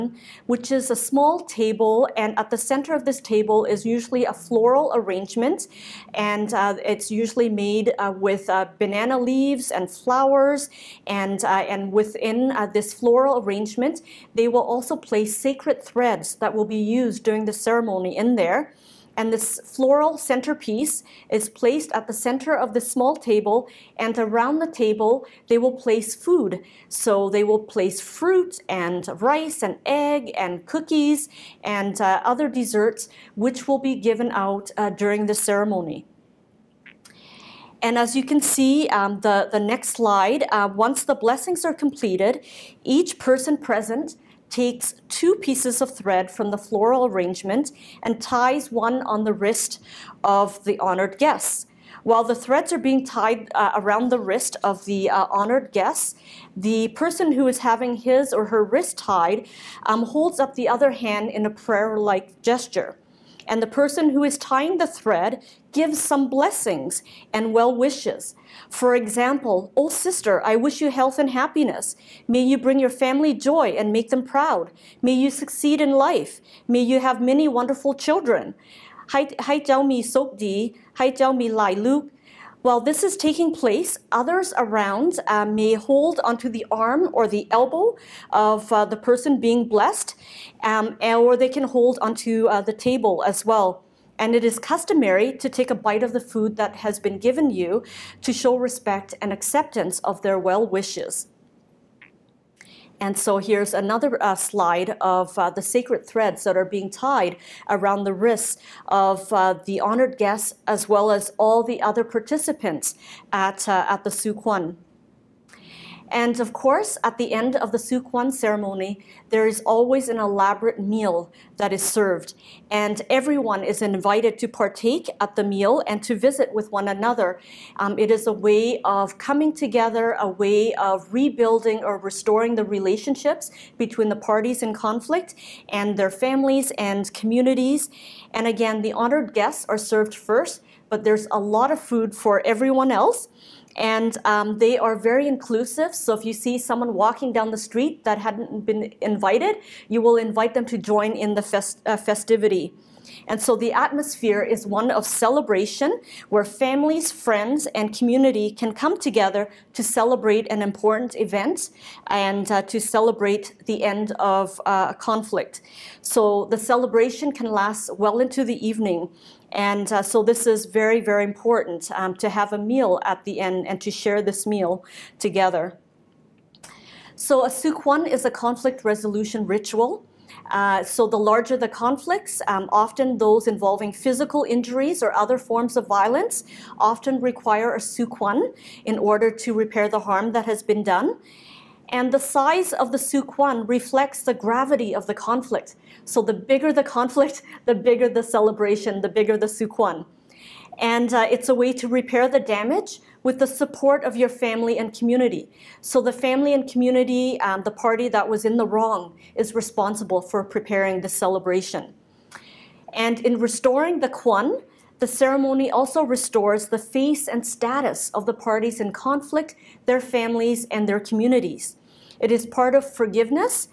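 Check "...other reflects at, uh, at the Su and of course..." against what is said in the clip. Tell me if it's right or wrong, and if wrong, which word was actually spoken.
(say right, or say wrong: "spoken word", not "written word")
wrong: "participants", not "reflects".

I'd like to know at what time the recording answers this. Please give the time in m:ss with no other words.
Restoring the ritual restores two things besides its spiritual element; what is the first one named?
3:36.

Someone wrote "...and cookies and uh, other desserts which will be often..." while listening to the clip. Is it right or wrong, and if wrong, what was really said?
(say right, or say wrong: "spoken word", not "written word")
wrong: "given", not "often".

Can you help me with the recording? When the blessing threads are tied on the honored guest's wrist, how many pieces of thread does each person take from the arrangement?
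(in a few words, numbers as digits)
2.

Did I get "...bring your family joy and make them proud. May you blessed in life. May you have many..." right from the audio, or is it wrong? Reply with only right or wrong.
wrong.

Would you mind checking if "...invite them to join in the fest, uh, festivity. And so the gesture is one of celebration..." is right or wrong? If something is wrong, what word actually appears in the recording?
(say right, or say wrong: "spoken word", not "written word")
wrong: "atmosphere", not "gesture".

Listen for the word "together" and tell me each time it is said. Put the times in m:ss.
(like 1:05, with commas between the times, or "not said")
2:09, 2:38, 2:55.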